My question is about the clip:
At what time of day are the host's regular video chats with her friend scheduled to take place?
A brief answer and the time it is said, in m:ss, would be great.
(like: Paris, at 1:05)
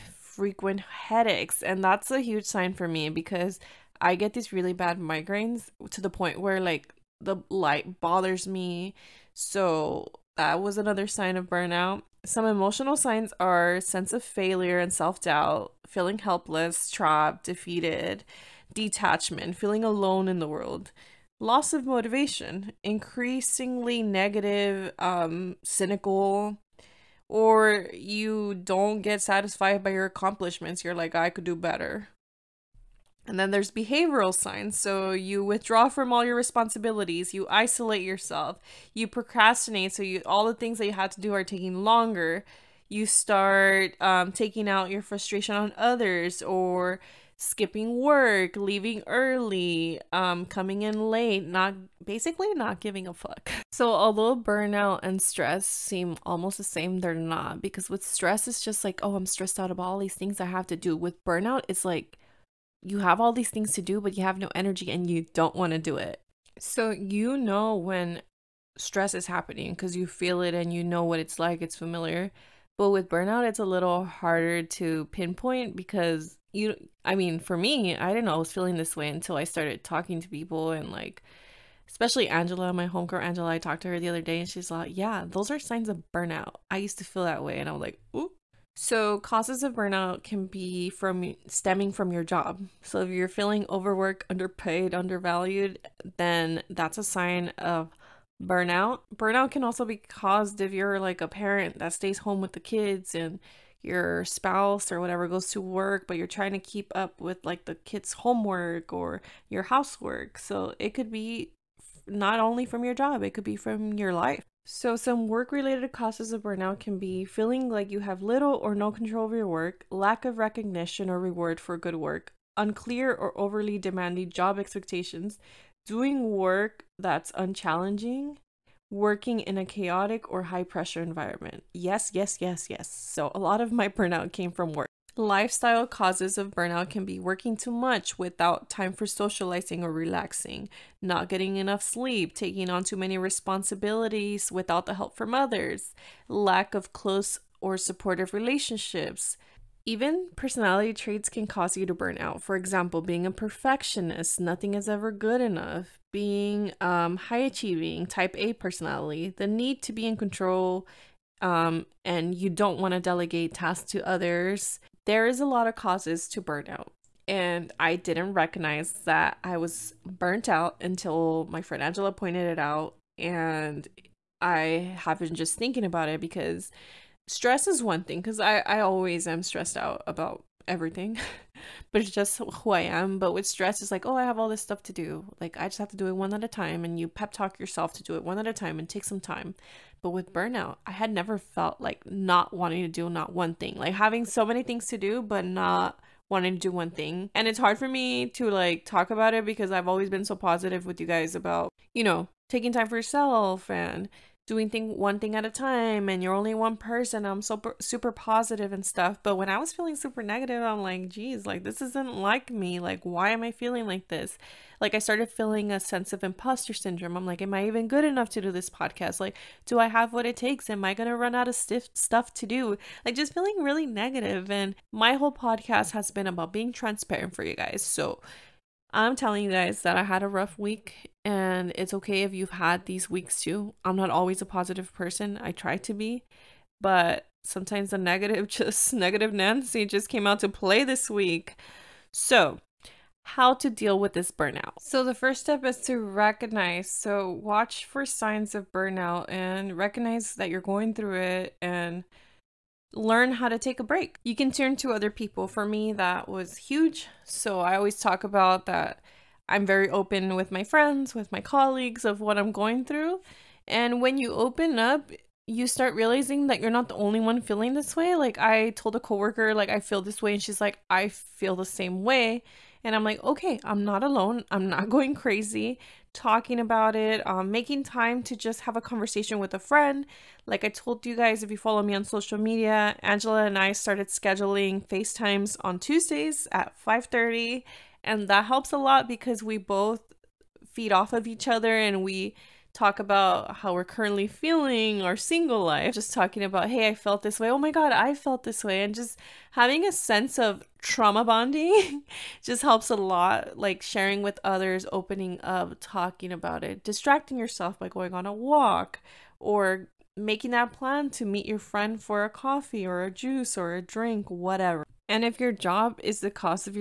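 5:30, at 4:46.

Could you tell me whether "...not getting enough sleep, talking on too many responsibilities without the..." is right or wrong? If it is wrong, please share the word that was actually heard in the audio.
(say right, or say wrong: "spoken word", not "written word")
wrong: "taking", not "talking".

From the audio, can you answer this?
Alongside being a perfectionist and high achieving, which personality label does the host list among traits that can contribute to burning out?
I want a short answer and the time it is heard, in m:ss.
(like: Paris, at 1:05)
type A, at 2:38.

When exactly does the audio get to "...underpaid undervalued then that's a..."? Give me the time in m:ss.
1:34.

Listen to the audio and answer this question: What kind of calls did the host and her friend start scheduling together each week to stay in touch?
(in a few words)
FaceTimes.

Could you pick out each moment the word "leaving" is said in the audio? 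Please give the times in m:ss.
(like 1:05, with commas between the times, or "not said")
0:48.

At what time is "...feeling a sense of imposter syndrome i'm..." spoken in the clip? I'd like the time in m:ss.
3:35.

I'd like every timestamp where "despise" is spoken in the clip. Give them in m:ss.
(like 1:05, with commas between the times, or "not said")
not said.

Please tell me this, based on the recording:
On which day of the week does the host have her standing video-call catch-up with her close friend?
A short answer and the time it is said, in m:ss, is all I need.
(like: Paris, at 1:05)
Tuesdays, at 4:45.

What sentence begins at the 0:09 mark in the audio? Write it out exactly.
So that was another sign of burnout.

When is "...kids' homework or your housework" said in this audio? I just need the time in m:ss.
1:47.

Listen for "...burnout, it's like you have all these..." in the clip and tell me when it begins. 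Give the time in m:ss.
1:01.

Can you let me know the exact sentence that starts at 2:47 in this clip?
And I didn't recognize that I was burnt out until my friend Angela pointed it out.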